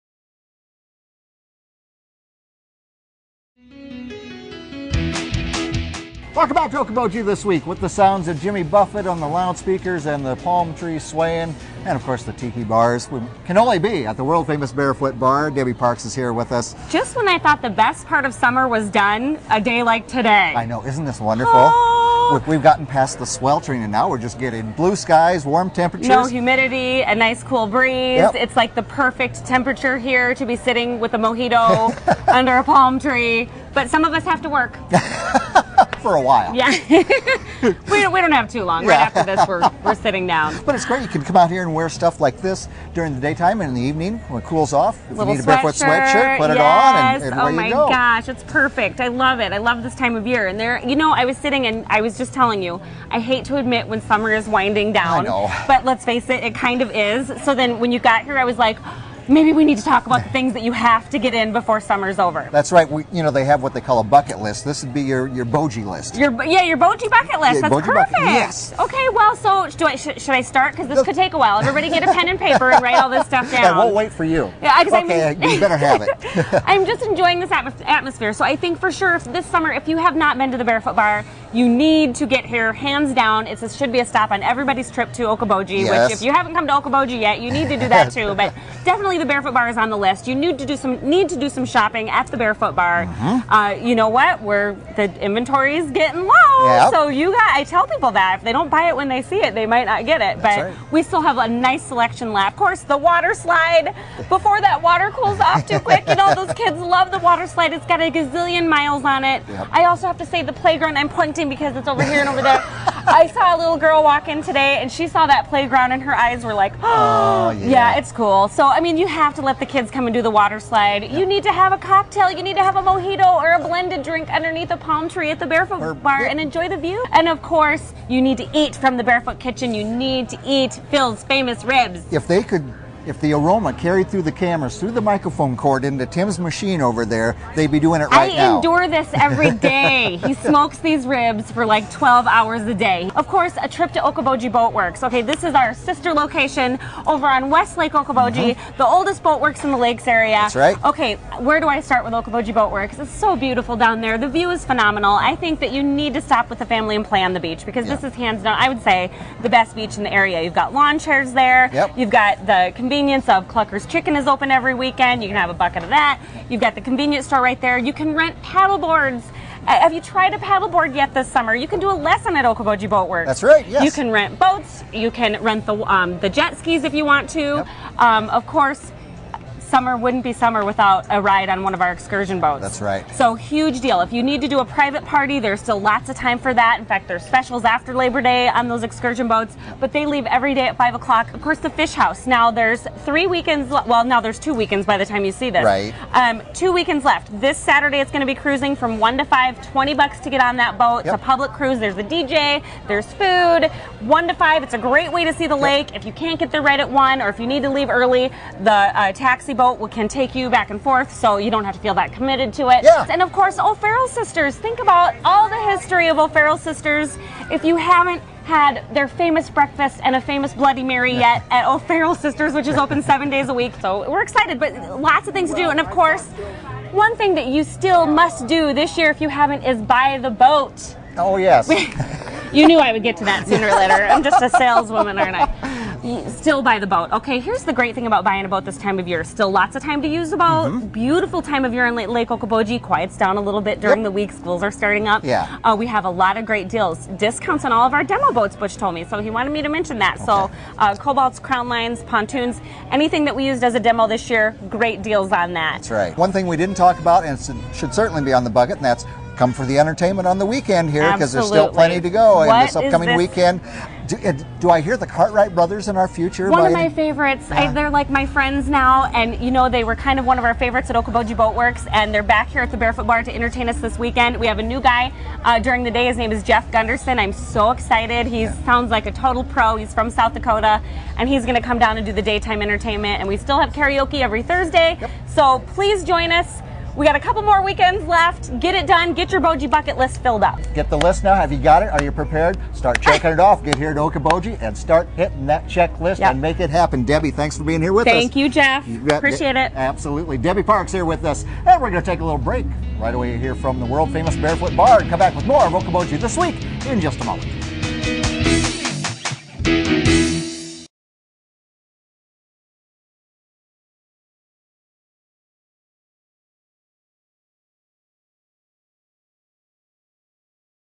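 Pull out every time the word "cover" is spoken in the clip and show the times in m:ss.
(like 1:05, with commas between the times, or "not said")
not said.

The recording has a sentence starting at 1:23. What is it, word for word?
it should be a stop on everybody's trip to Okoboji, yes.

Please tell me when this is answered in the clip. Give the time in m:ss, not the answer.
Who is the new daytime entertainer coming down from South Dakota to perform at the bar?
4:36.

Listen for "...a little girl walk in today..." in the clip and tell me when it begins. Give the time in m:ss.
1:53.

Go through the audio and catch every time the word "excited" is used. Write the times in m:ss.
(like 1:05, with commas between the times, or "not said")
3:44, 4:37.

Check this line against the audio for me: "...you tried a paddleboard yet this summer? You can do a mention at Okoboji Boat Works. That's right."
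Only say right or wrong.
wrong.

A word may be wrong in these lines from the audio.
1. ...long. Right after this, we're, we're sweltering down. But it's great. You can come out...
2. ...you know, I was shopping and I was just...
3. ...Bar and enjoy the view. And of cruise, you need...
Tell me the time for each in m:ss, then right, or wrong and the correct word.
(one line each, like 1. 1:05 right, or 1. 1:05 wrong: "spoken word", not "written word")
1. 0:38 wrong: "sitting", not "sweltering"
2. 0:50 wrong: "sitting", not "shopping"
3. 2:06 wrong: "course", not "cruise".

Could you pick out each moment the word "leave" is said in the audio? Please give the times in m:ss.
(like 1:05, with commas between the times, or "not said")
3:10, 3:27.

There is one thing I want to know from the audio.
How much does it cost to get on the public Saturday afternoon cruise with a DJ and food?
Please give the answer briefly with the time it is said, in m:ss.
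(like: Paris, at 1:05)
$20, at 3:19.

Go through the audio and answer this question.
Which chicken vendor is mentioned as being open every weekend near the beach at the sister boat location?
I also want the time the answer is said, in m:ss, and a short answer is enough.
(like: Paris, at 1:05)
Clucker's Chicken, at 2:43.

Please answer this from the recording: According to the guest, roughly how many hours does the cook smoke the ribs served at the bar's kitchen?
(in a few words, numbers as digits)
12.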